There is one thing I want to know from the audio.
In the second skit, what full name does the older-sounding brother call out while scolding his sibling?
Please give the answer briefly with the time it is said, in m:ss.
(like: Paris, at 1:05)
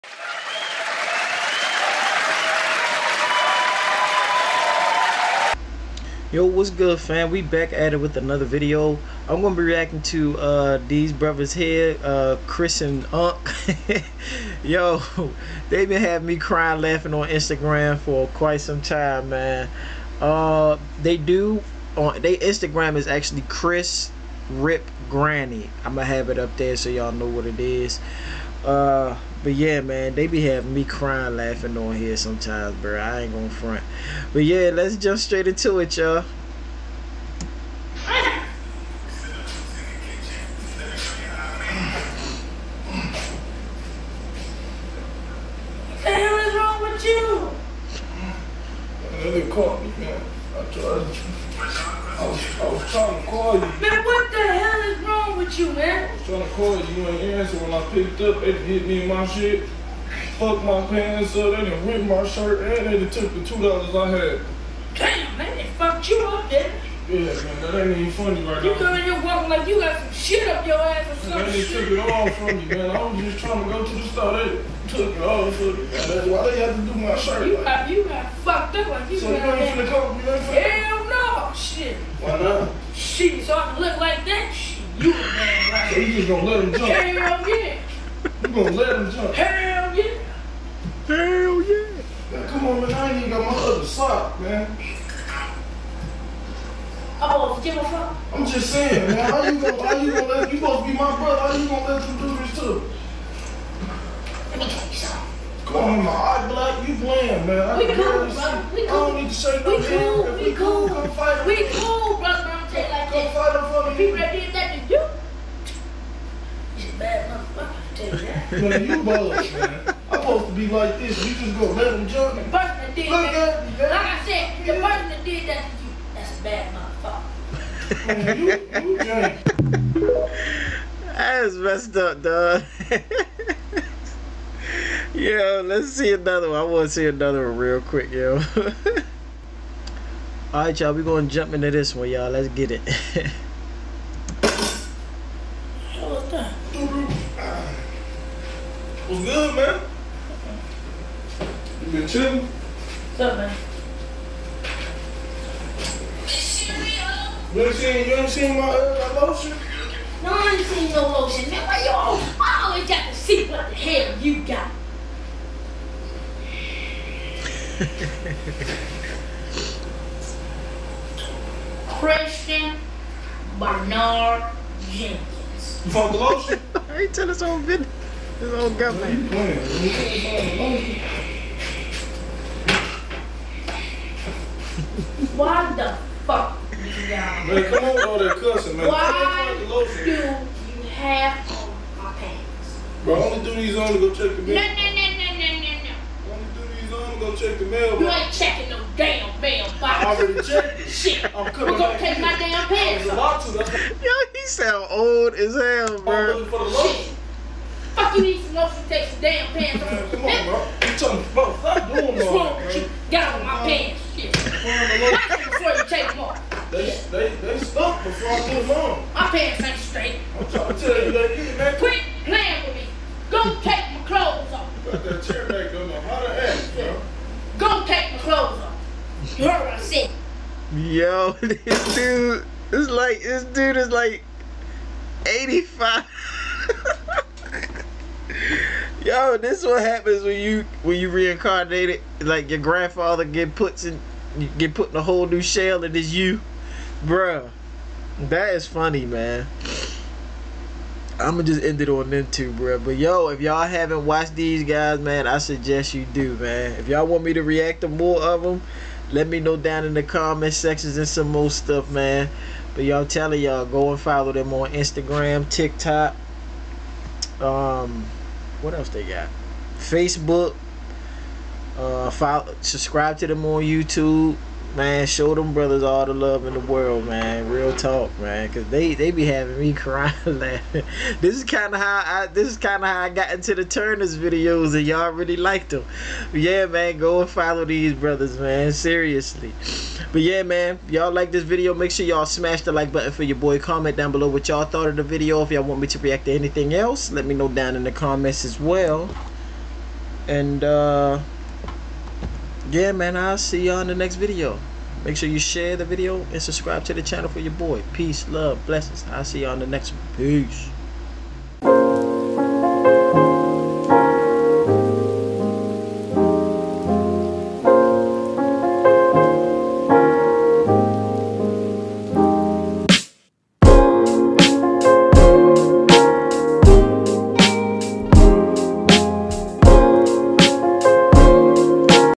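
Christian Bernard Jenkins, at 2:51.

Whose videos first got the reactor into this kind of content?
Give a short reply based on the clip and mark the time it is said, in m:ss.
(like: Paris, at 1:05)
The Turners, at 4:43.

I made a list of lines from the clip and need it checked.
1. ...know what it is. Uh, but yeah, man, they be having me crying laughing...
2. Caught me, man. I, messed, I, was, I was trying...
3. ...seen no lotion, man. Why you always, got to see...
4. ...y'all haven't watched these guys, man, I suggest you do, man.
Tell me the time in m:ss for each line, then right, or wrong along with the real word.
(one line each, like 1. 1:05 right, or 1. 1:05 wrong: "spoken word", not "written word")
1. 0:27 right
2. 0:49 wrong: "tried", not "messed"
3. 2:40 right
4. 4:13 right.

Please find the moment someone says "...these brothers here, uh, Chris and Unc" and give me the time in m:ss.
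0:10.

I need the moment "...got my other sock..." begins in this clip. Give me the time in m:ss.
1:33.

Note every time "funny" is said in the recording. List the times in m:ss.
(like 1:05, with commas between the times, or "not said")
1:08, 4:08.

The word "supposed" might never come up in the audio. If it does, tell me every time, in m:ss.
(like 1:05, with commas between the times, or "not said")
1:40, 2:00.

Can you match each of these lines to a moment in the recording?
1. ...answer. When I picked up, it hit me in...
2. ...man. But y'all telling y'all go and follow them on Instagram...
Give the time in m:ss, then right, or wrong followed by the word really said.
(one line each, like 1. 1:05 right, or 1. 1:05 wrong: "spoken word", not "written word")
1. 0:57 right
2. 4:21 right.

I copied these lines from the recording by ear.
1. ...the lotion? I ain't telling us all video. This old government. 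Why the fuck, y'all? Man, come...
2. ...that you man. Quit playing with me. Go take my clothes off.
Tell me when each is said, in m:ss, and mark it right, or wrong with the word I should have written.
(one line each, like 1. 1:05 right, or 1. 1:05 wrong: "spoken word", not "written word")
1. 2:56 right
2. 3:41 right.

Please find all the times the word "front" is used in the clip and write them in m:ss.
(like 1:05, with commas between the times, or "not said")
0:33, 1:53.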